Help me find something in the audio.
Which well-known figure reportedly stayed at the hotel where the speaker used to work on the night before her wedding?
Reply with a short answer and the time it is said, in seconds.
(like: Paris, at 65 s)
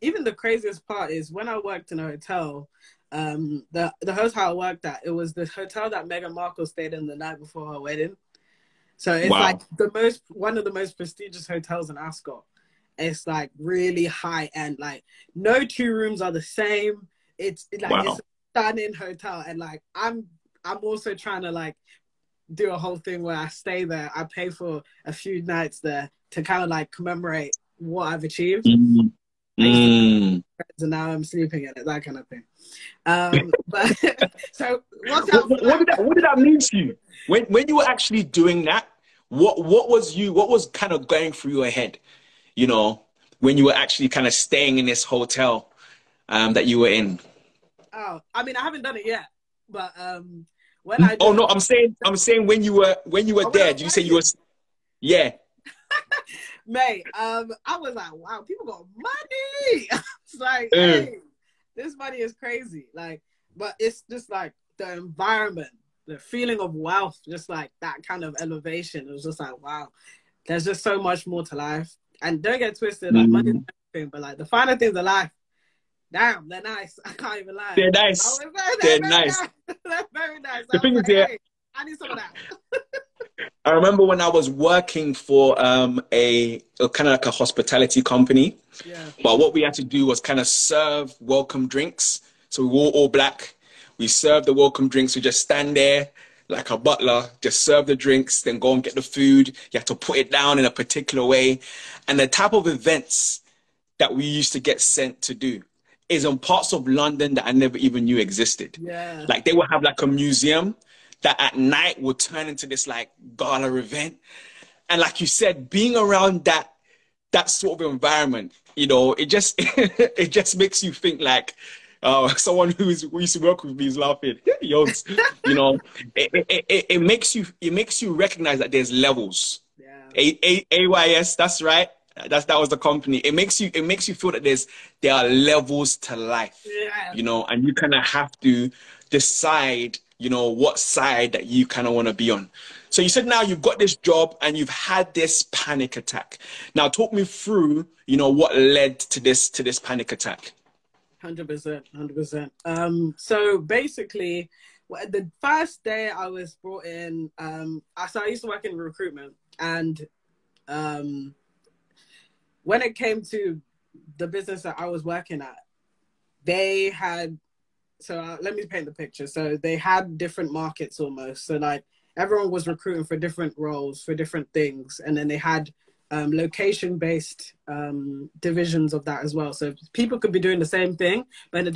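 Meghan Markle, at 6 s.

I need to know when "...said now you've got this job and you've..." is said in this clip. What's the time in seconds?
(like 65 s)
143 s.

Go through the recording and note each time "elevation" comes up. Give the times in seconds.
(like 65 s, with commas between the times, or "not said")
68 s.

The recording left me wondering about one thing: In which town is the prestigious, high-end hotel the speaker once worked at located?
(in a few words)
Ascot.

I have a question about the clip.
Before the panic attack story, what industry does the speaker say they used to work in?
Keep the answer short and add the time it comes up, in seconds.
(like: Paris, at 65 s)
recruitment, at 158 s.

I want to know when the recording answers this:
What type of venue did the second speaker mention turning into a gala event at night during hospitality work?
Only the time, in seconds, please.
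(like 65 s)
110 s.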